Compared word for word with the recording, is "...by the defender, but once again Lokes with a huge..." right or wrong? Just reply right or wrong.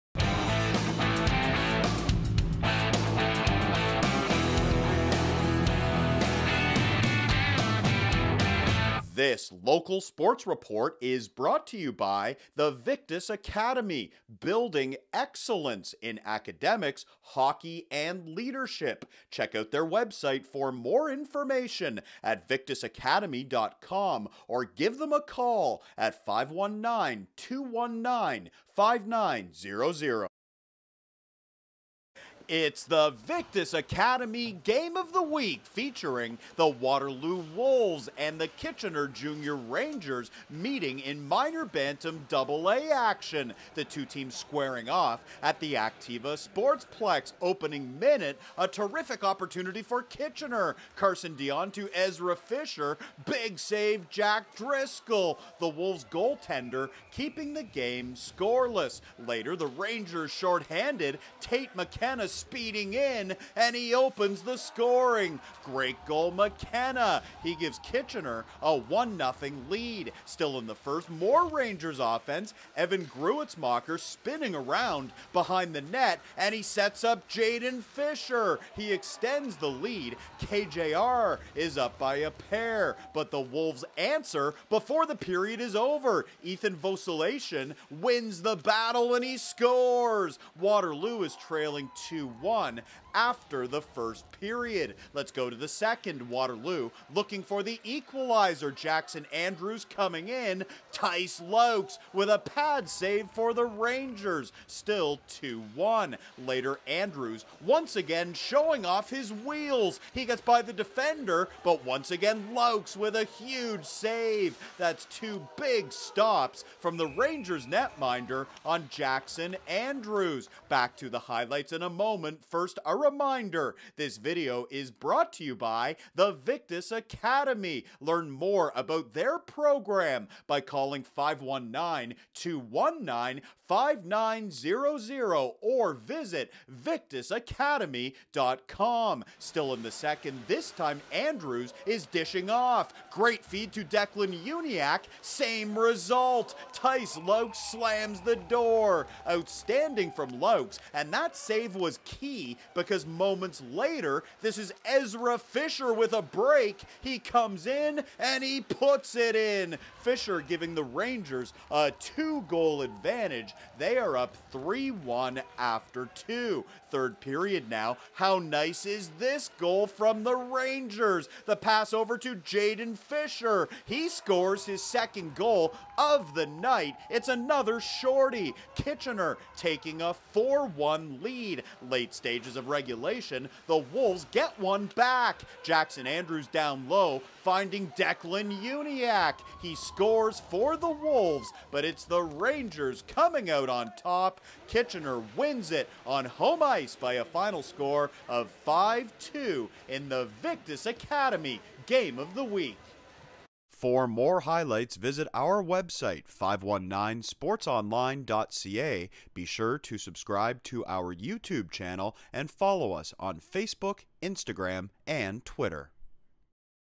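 right.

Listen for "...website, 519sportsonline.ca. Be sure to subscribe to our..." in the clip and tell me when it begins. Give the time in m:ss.
3:25.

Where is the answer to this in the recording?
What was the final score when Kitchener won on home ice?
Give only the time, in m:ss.
3:18.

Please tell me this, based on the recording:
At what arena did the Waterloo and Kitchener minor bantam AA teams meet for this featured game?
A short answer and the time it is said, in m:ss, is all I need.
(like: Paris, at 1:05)
Activa Sportsplex, at 0:45.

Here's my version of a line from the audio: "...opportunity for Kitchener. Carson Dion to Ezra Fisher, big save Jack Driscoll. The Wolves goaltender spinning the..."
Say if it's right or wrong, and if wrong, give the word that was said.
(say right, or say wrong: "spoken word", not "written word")
wrong: "keeping", not "spinning".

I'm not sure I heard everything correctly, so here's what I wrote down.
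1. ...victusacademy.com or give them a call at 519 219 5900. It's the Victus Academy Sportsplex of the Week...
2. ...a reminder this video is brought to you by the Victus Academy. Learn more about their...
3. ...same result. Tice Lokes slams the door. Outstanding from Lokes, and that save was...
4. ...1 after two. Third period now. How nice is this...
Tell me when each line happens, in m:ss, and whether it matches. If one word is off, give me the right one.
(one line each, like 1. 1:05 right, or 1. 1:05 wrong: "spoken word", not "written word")
1. 0:22 wrong: "Game", not "Sportsplex"
2. 2:02 right
3. 2:25 right
4. 2:44 right.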